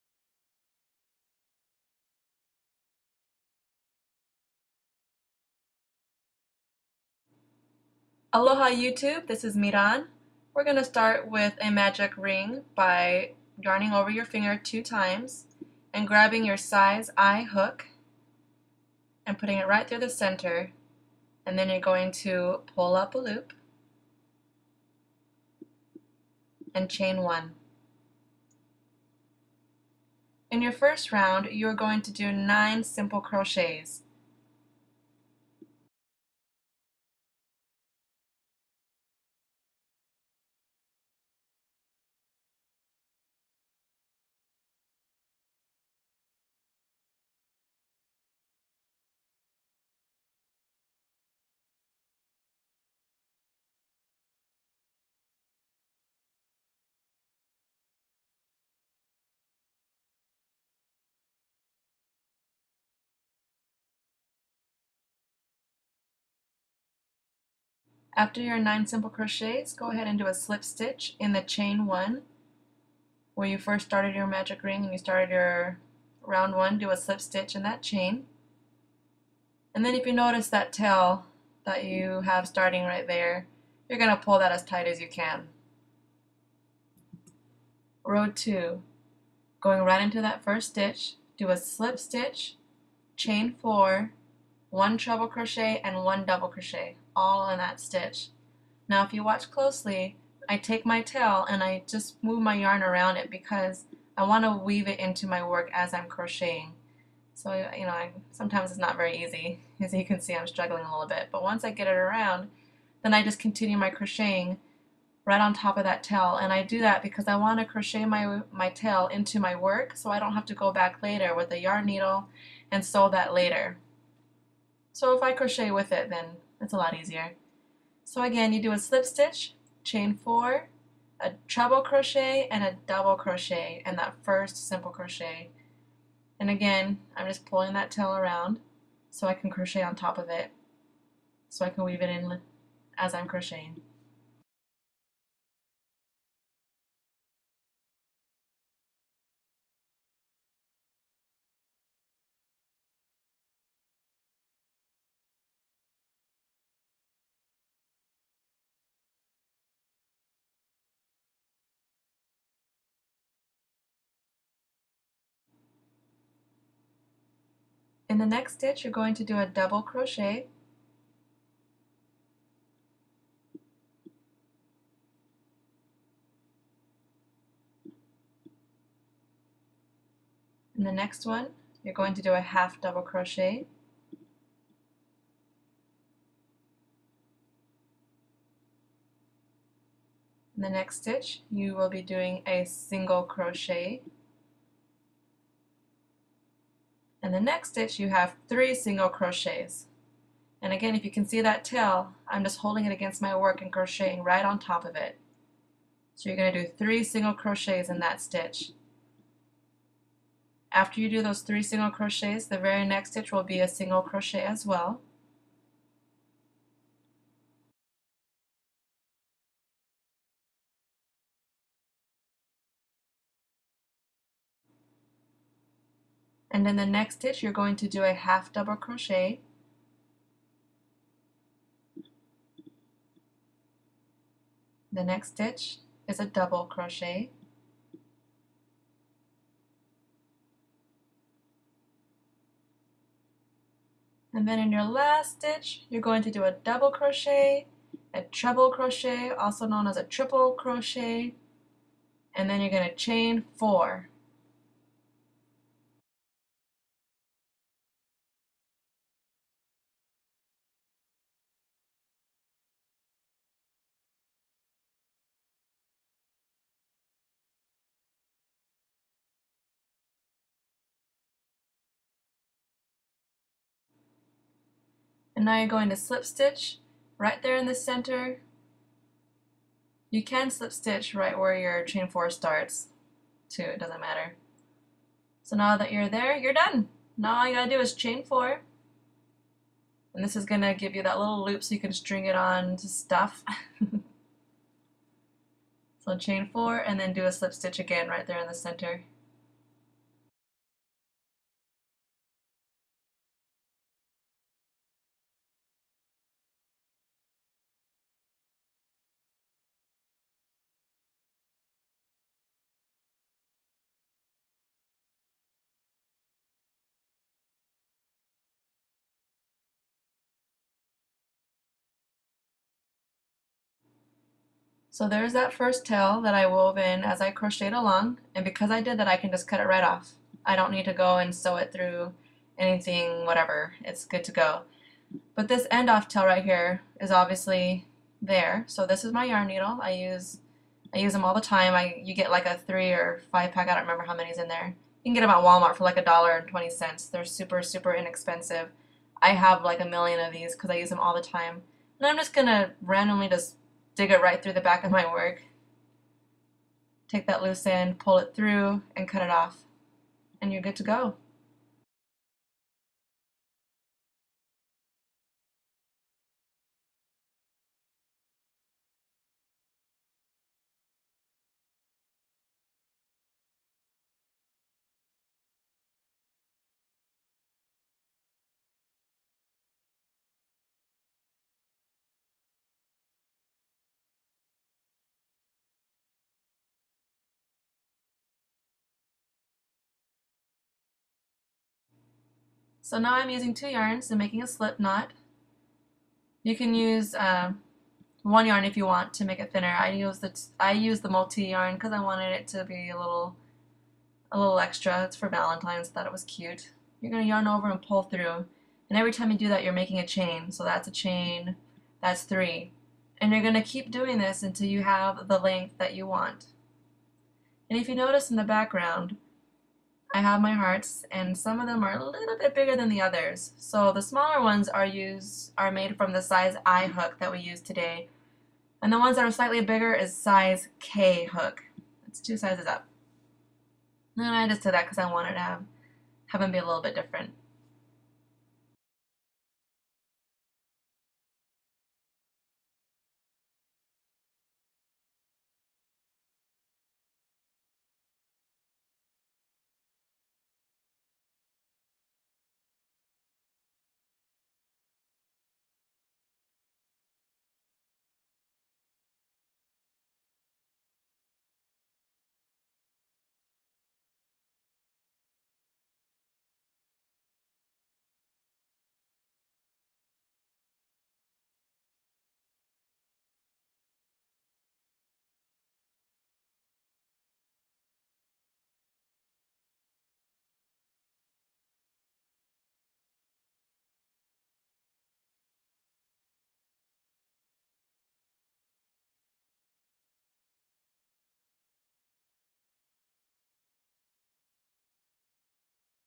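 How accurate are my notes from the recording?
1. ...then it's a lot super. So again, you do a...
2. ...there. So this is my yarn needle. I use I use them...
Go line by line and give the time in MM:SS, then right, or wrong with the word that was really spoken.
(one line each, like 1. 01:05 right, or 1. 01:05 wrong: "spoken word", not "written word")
1. 02:06 wrong: "easier", not "super"
2. 05:38 right.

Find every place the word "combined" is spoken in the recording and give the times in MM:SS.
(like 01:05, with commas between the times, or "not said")
not said.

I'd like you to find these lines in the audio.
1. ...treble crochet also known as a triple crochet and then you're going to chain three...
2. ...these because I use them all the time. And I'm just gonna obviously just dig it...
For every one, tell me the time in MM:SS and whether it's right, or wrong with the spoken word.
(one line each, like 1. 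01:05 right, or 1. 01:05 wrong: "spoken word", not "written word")
1. 04:08 wrong: "four", not "three"
2. 05:50 wrong: "randomly", not "obviously".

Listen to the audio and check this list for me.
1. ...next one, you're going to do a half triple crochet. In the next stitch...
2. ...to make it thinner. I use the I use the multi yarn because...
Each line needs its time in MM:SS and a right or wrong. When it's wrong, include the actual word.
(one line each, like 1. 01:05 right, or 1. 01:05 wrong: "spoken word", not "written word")
1. 03:00 wrong: "double", not "triple"
2. 06:39 right.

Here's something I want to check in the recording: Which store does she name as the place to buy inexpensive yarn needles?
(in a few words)
Walmart.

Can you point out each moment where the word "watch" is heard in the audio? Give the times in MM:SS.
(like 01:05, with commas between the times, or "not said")
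01:39.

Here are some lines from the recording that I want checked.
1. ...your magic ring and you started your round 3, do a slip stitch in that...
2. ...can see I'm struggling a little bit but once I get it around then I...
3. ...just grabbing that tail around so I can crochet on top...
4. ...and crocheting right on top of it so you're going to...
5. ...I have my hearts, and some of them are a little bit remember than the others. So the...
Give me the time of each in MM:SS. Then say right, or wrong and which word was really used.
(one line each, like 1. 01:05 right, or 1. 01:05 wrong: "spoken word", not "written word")
1. 01:14 wrong: "1", not "3"
2. 01:50 right
3. 02:17 wrong: "pulling", not "grabbing"
4. 03:23 right
5. 07:00 wrong: "bigger", not "remember".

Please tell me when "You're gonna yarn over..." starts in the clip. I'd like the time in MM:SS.
06:46.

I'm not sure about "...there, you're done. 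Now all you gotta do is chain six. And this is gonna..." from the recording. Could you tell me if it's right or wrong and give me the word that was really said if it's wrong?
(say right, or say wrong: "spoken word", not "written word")
wrong: "four", not "six".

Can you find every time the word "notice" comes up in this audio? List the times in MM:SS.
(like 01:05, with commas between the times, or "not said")
01:20, 06:57.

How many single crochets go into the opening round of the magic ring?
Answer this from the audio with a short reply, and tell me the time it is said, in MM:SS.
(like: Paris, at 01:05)
9, at 00:32.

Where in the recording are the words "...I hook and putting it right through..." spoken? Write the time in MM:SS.
00:17.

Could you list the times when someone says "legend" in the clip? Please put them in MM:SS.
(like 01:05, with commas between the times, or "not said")
not said.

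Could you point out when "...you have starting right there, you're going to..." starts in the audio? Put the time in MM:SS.
01:21.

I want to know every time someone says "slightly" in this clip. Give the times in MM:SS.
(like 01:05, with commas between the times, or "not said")
07:09.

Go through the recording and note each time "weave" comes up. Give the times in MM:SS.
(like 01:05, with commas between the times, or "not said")
01:44, 02:21.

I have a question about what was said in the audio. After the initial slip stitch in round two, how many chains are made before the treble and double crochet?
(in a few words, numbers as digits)
4.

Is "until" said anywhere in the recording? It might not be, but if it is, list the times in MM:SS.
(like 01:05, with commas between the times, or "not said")
06:54.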